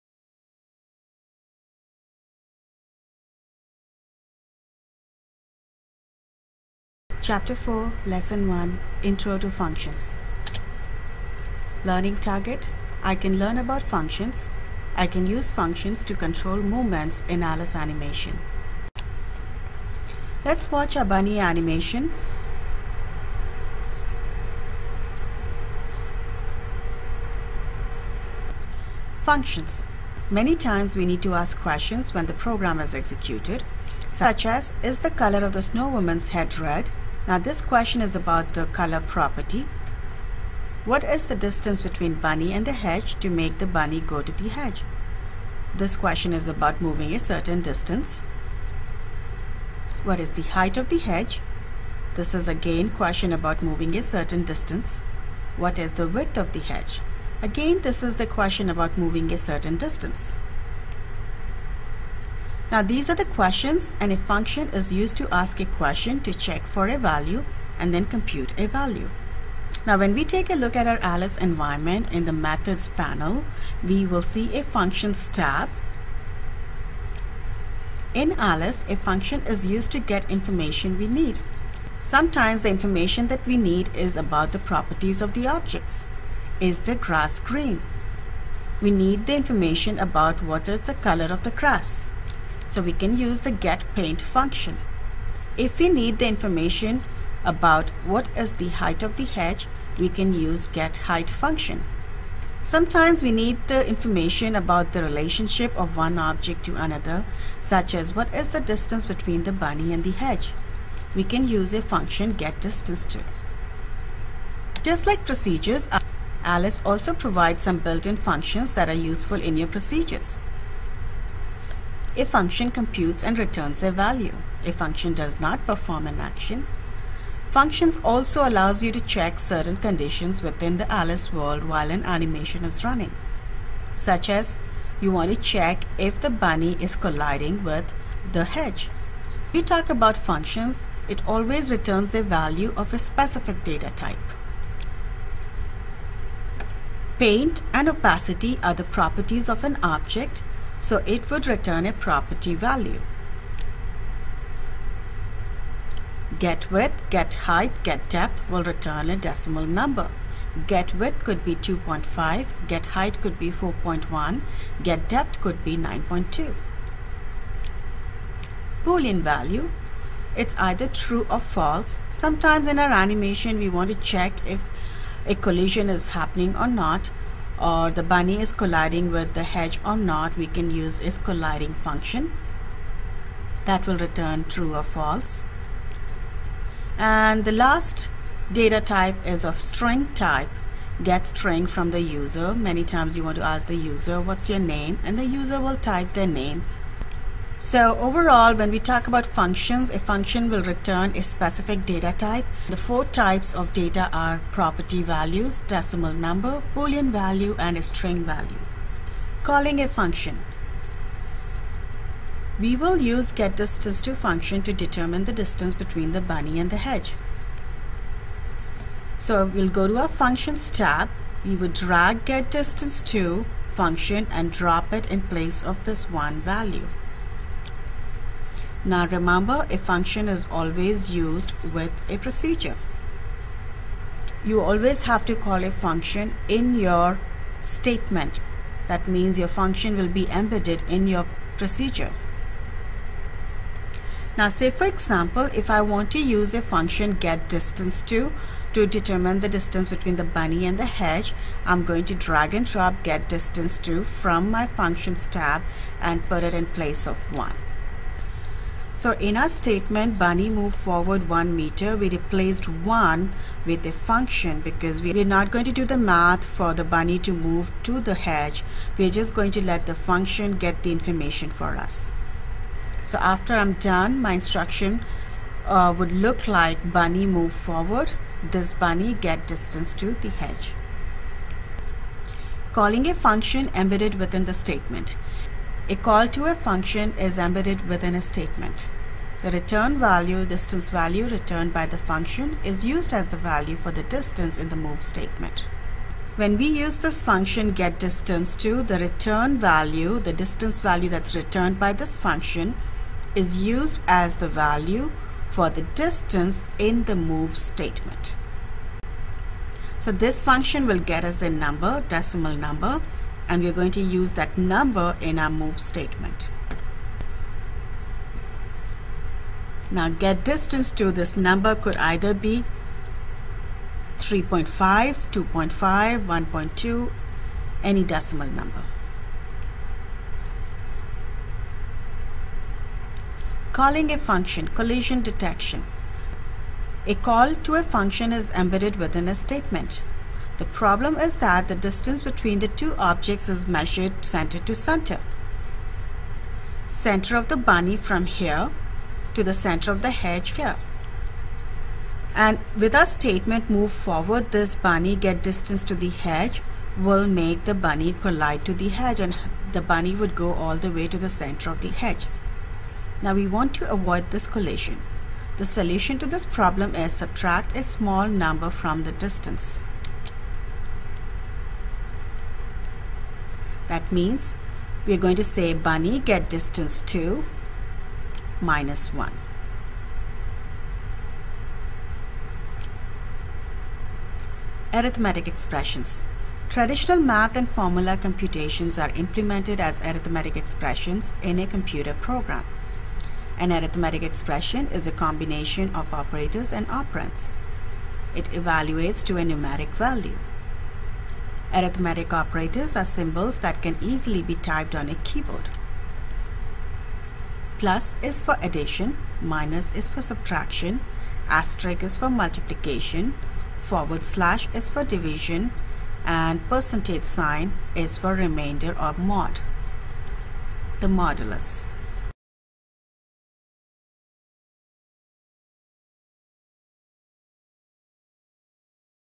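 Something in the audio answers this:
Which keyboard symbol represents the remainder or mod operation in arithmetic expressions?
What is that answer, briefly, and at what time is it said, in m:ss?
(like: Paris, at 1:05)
percentage sign, at 6:56.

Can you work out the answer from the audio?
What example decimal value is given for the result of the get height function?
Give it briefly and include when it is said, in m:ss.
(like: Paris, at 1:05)
4.1, at 2:43.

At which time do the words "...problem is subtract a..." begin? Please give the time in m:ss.
6:06.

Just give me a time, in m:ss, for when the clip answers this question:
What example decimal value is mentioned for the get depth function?
2:45.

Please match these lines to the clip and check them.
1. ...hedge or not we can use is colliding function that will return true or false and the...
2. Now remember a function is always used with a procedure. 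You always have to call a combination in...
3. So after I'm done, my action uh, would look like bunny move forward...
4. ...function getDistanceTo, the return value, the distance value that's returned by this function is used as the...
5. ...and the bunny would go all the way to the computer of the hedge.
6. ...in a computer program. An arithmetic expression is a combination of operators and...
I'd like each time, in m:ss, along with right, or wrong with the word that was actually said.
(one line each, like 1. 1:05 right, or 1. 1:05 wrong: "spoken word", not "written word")
1. 2:59 right
2. 3:48 wrong: "function", not "combination"
3. 4:33 wrong: "instruction", not "action"
4. 4:57 right
5. 5:59 wrong: "center", not "computer"
6. 6:31 right.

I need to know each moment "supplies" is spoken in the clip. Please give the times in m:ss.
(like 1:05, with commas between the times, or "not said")
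not said.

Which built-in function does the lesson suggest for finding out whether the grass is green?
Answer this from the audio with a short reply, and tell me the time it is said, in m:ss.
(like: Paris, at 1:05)
getPaint, at 1:33.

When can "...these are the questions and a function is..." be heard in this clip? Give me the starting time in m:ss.
1:02.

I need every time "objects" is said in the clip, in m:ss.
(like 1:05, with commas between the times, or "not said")
1:25, 1:46, 2:29, 5:42.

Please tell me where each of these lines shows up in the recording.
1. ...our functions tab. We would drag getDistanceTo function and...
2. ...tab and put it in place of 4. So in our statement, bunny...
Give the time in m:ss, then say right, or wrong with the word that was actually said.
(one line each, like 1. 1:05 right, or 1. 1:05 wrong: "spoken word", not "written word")
1. 3:39 right
2. 4:15 wrong: "1", not "4".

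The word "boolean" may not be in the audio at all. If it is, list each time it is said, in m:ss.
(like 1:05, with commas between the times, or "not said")
2:48, 3:26.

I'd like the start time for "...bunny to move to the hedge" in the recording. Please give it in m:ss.
4:26.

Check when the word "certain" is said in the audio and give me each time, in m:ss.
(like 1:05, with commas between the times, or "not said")
0:47, 0:54, 0:59, 2:09.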